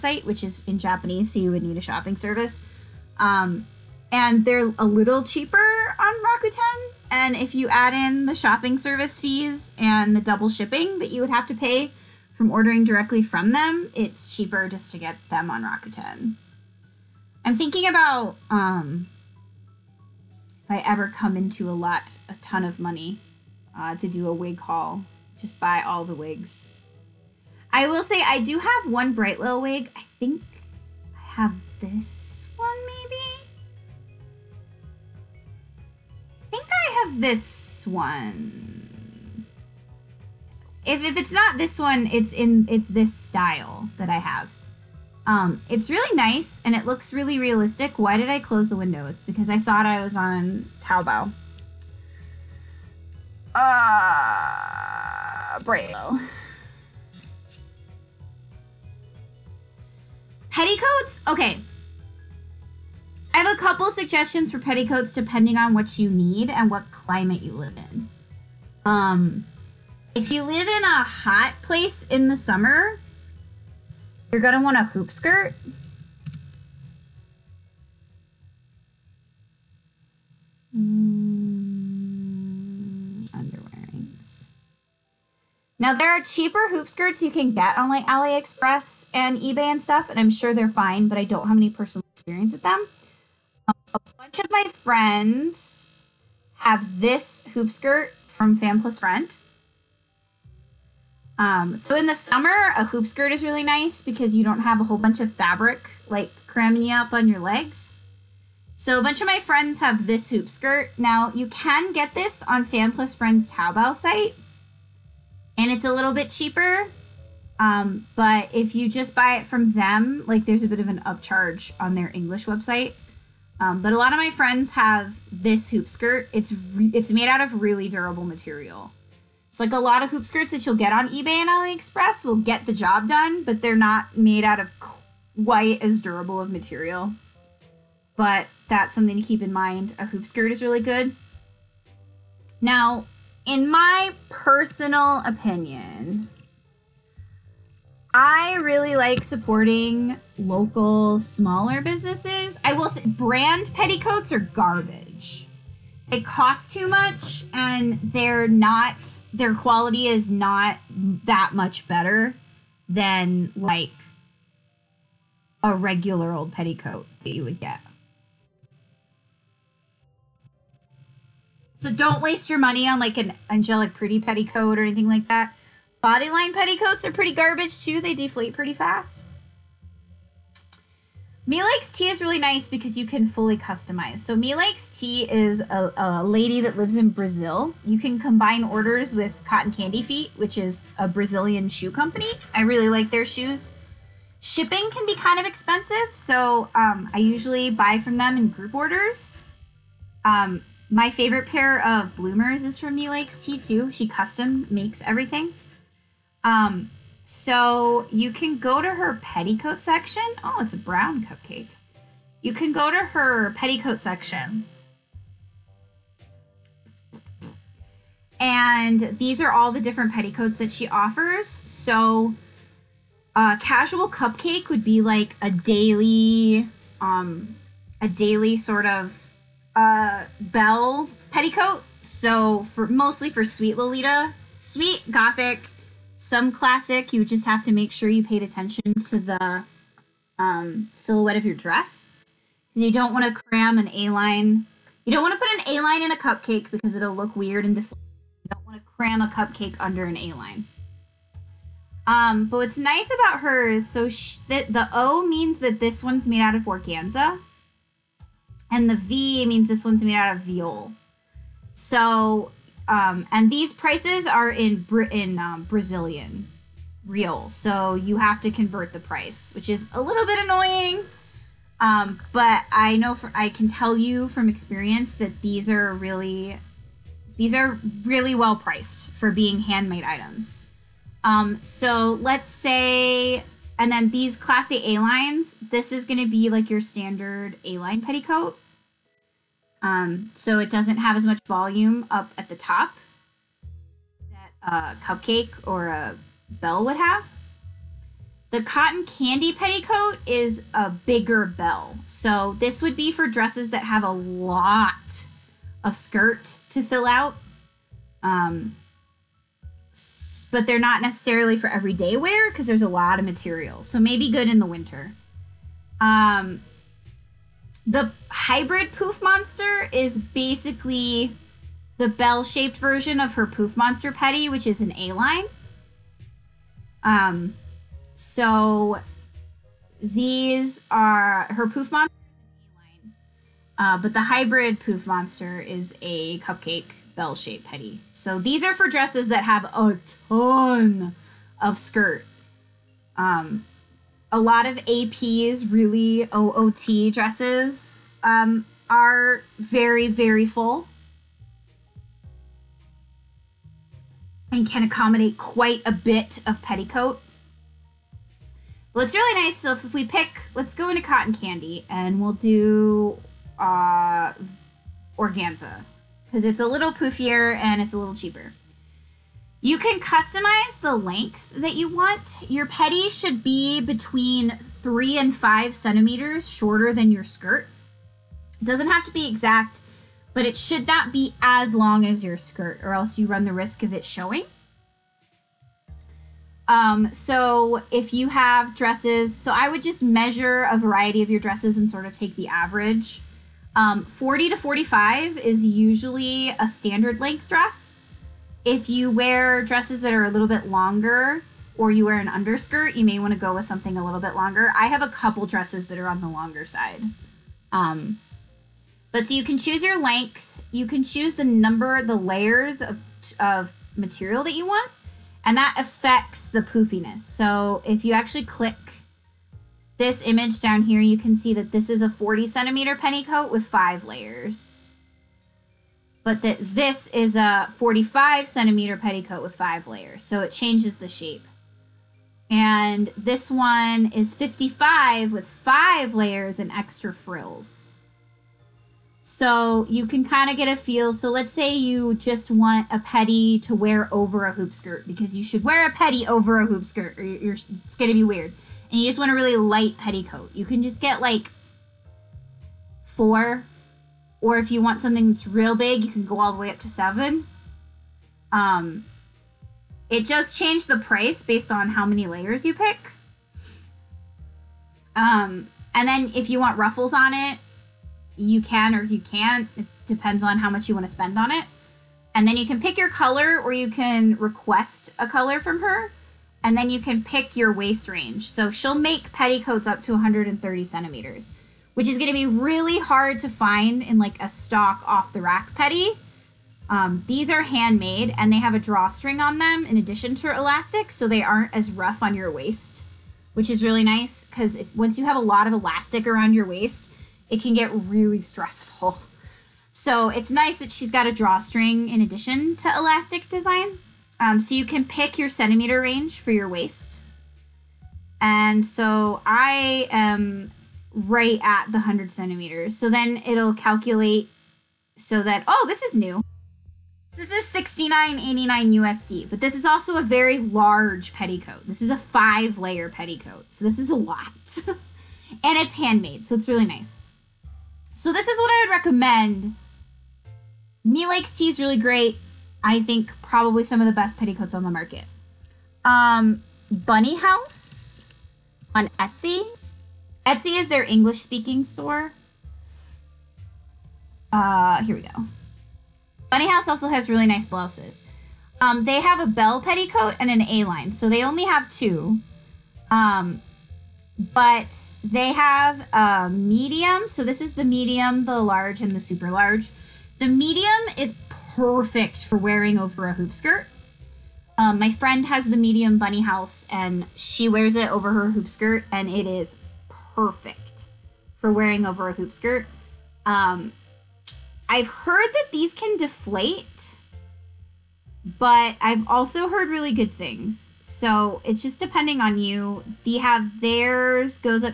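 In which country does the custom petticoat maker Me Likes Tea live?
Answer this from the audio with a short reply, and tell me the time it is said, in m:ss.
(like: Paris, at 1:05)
Brazil, at 3:07.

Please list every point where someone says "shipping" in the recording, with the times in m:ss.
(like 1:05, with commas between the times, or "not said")
0:10, 3:14.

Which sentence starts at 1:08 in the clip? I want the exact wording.
Um, if you live in a hot place in the summer, you're gonna want a hoop skirt.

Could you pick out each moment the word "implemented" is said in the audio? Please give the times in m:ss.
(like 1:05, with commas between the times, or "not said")
not said.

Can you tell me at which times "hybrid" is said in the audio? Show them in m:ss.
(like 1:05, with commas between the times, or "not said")
5:18, 5:34.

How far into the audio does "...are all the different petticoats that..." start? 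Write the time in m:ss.
3:39.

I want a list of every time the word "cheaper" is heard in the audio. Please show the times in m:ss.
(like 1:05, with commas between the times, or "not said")
0:05, 0:14, 1:26, 1:56, 6:08.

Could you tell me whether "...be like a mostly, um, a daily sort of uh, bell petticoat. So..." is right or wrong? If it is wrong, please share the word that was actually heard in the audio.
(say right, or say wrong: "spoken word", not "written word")
wrong: "daily", not "mostly".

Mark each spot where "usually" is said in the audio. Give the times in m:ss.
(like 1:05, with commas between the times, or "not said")
3:17, 6:35.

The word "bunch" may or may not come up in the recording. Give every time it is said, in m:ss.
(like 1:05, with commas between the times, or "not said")
1:34, 1:44, 1:49.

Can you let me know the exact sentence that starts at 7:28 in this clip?
And you just want a really light petticoat.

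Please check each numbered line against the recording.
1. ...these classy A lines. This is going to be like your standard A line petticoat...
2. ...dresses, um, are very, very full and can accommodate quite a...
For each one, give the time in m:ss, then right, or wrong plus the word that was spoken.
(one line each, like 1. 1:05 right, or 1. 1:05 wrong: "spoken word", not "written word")
1. 4:44 right
2. 5:47 right.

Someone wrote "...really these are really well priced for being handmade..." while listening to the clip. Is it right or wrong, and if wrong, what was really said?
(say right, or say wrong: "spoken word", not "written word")
right.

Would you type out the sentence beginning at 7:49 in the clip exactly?
It depends on how much you want to spend on it.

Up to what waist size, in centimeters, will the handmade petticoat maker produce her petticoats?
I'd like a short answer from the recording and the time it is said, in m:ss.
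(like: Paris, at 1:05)
130, at 8:00.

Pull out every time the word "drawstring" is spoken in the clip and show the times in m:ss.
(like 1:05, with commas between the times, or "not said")
8:08, 8:21.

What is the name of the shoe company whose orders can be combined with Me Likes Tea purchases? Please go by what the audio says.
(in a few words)
Cotton Candy Feet.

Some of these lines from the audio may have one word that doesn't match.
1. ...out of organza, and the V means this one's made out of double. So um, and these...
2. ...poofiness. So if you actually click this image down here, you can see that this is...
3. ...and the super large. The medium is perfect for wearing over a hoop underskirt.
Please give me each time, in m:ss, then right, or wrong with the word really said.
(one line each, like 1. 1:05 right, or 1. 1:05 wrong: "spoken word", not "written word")
1. 4:16 wrong: "voile", not "double"
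2. 6:56 right
3. 9:19 wrong: "skirt", not "underskirt".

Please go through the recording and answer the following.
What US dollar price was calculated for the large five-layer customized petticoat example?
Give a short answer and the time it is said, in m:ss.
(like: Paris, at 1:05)
$69.89, at 8:37.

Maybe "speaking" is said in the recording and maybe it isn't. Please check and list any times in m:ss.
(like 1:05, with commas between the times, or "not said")
9:01.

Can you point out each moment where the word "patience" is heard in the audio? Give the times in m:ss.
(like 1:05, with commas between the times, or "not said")
not said.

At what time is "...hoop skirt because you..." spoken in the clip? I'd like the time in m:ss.
7:24.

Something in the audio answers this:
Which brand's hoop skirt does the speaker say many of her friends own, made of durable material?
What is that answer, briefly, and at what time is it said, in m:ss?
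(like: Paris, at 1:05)
Fan Plus Friend, at 1:38.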